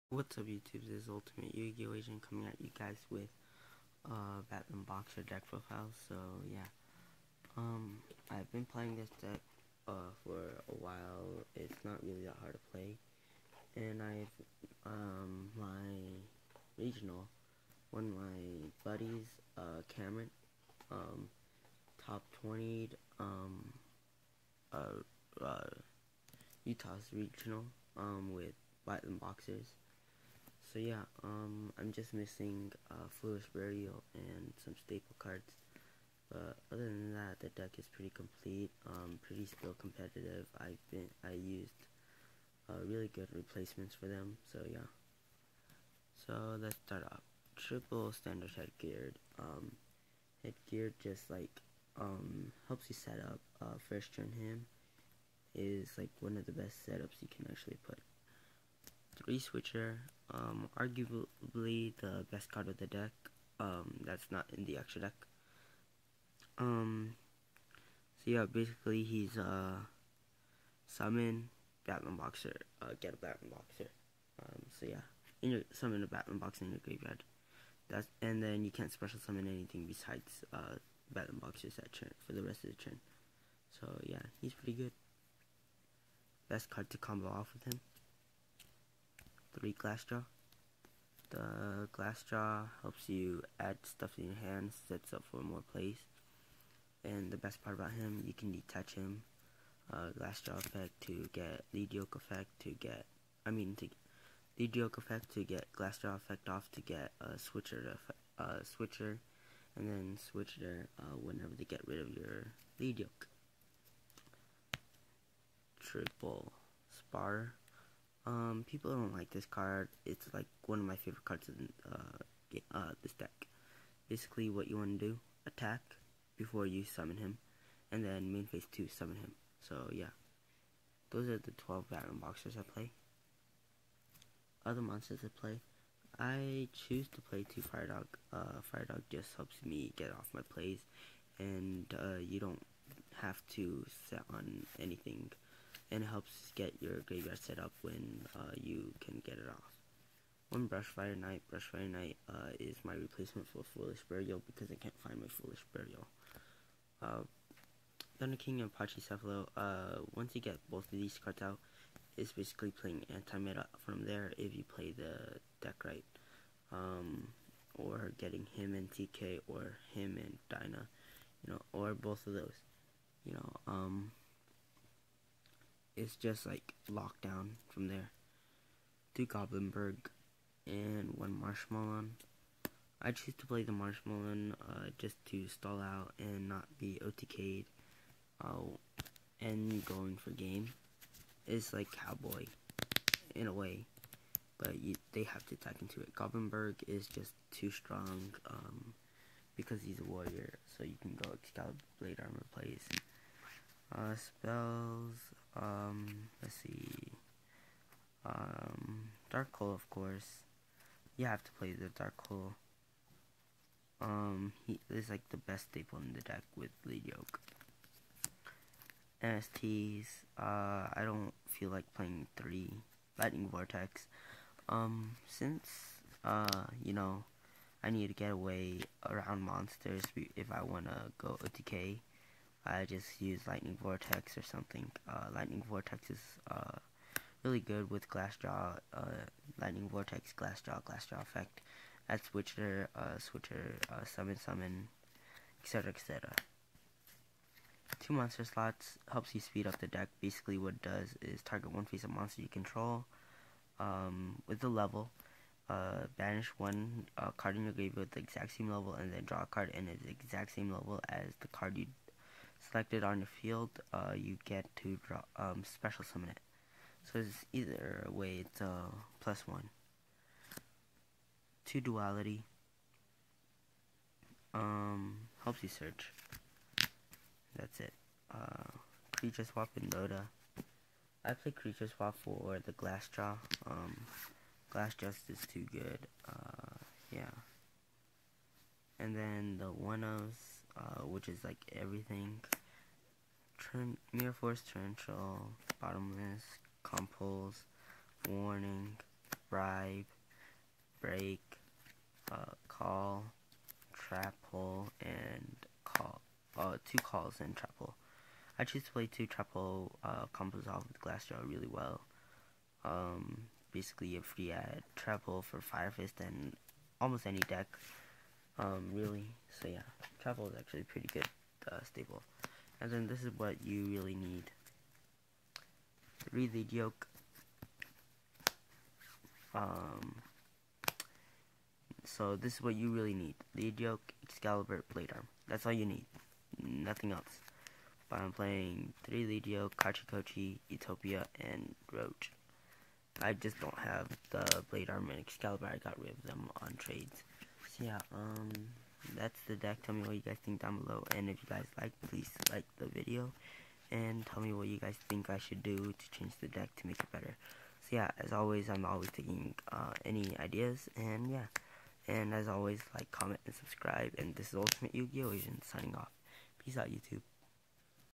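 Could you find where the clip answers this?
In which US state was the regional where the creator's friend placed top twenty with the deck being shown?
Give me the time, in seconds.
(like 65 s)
26 s.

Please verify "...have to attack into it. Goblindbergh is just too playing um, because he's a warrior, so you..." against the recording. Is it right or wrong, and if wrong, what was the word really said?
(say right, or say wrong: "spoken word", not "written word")
wrong: "strong", not "playing".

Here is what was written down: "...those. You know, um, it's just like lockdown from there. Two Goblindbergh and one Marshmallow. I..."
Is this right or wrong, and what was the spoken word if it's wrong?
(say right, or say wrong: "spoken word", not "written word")
right.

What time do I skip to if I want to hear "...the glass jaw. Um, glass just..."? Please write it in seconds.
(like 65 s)
282 s.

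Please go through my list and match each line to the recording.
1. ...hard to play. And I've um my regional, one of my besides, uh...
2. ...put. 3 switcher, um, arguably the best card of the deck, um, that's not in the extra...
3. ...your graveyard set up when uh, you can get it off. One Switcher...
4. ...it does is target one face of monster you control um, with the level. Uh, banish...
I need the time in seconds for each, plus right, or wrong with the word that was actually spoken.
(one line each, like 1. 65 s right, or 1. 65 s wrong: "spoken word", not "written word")
1. 12 s wrong: "buddies", not "besides"
2. 57 s right
3. 146 s wrong: "Brushfire", not "Switcher"
4. 250 s right.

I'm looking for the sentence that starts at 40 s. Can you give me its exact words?
I've been, I used uh, really good replacements for them, so yeah.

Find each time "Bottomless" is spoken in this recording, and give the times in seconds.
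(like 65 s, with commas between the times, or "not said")
295 s.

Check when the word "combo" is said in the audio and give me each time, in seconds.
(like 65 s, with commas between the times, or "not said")
86 s, 310 s.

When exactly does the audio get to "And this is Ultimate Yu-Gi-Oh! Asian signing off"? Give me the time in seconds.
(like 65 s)
364 s.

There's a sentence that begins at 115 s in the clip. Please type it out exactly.
Triple spar um, people don't like this card.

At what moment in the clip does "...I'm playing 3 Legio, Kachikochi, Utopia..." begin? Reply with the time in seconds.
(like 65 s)
338 s.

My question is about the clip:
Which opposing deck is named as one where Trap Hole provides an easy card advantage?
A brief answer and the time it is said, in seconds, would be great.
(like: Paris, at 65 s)
Fire Fist, at 315 s.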